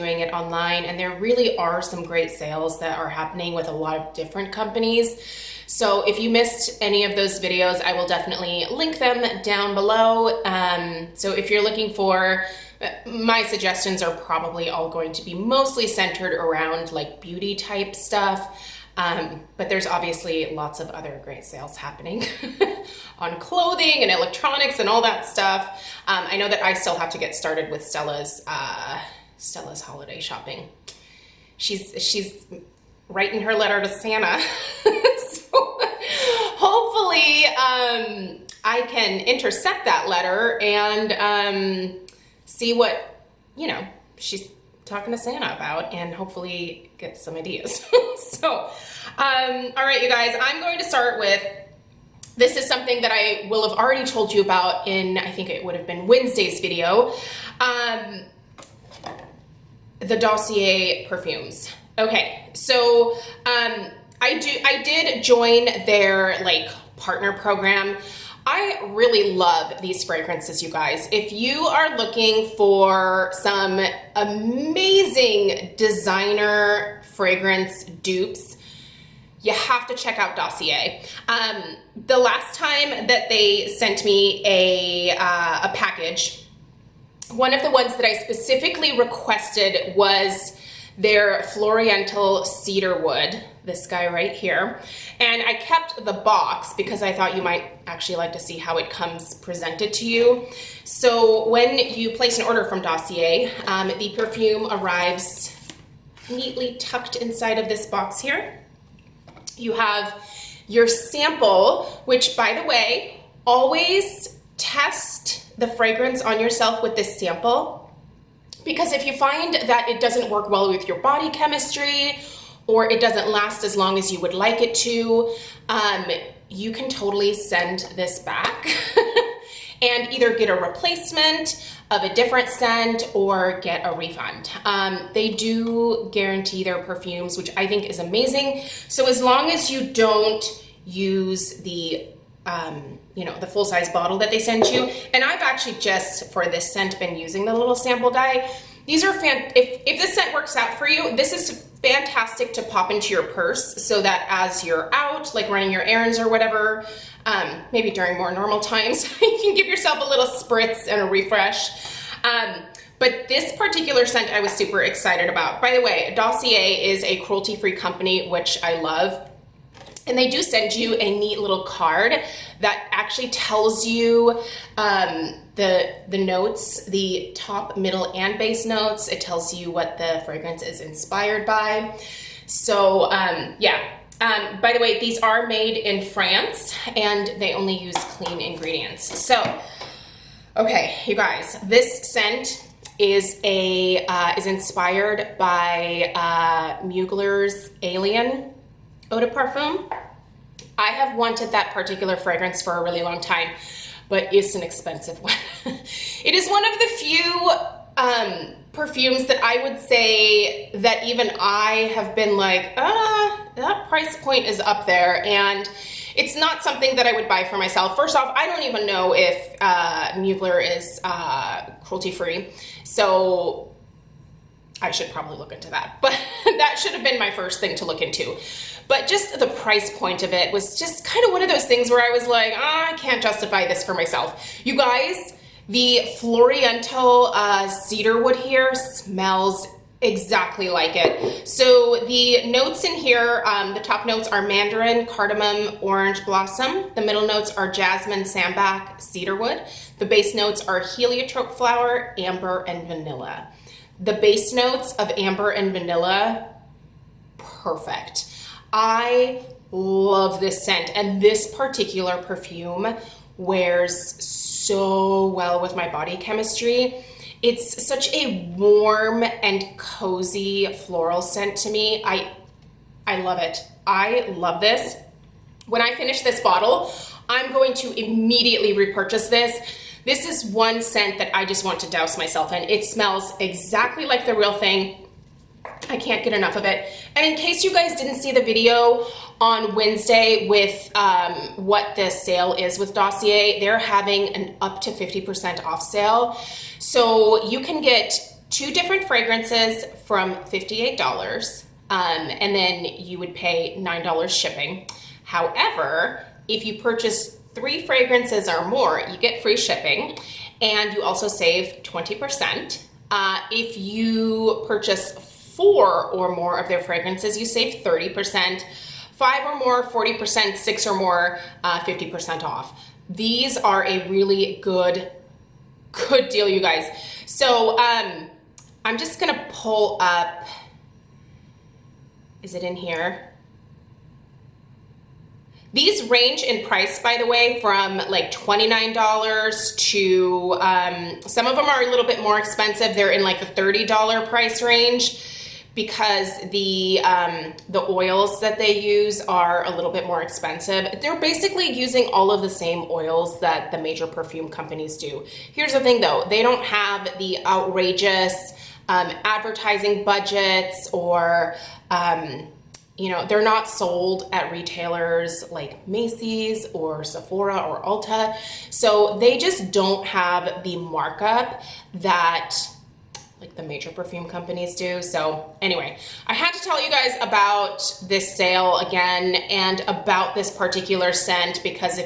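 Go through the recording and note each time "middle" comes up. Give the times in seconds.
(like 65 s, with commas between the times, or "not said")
177 s, 246 s.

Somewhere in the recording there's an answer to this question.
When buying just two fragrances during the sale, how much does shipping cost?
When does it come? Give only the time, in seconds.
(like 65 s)
303 s.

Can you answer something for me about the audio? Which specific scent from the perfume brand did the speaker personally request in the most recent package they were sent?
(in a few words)
Floriental Cedarwood.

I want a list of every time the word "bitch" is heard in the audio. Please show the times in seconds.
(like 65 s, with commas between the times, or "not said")
not said.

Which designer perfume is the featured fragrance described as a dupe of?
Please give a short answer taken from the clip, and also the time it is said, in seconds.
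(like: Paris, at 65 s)
Mugler's Alien Eau de Parfum, at 196 s.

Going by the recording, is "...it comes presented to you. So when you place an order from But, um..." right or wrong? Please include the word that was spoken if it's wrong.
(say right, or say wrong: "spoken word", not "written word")
wrong: "Dossier", not "But".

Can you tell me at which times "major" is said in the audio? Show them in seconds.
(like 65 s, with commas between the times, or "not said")
353 s, 373 s.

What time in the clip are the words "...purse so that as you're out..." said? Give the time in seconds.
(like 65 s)
153 s.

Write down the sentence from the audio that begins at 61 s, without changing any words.
Okay, so um, I do I did join their like partner program.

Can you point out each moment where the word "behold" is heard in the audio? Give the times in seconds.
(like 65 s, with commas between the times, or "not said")
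not said.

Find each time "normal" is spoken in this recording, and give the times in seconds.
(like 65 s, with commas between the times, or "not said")
158 s.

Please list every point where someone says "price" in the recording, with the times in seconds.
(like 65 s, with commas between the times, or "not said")
213 s, 229 s, 336 s, 344 s.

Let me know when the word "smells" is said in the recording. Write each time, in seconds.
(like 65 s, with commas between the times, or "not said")
238 s, 282 s.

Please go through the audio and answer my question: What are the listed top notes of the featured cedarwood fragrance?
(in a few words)
mandarin, cardamom, orange blossom.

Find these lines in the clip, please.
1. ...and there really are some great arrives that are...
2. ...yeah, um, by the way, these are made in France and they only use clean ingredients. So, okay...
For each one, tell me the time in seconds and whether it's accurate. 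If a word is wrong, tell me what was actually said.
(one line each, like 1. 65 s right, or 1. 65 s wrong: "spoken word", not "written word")
1. 0 s wrong: "sales", not "arrives"
2. 183 s right.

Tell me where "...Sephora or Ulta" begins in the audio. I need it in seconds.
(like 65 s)
367 s.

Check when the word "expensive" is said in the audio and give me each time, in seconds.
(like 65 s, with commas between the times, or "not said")
204 s, 342 s, 350 s.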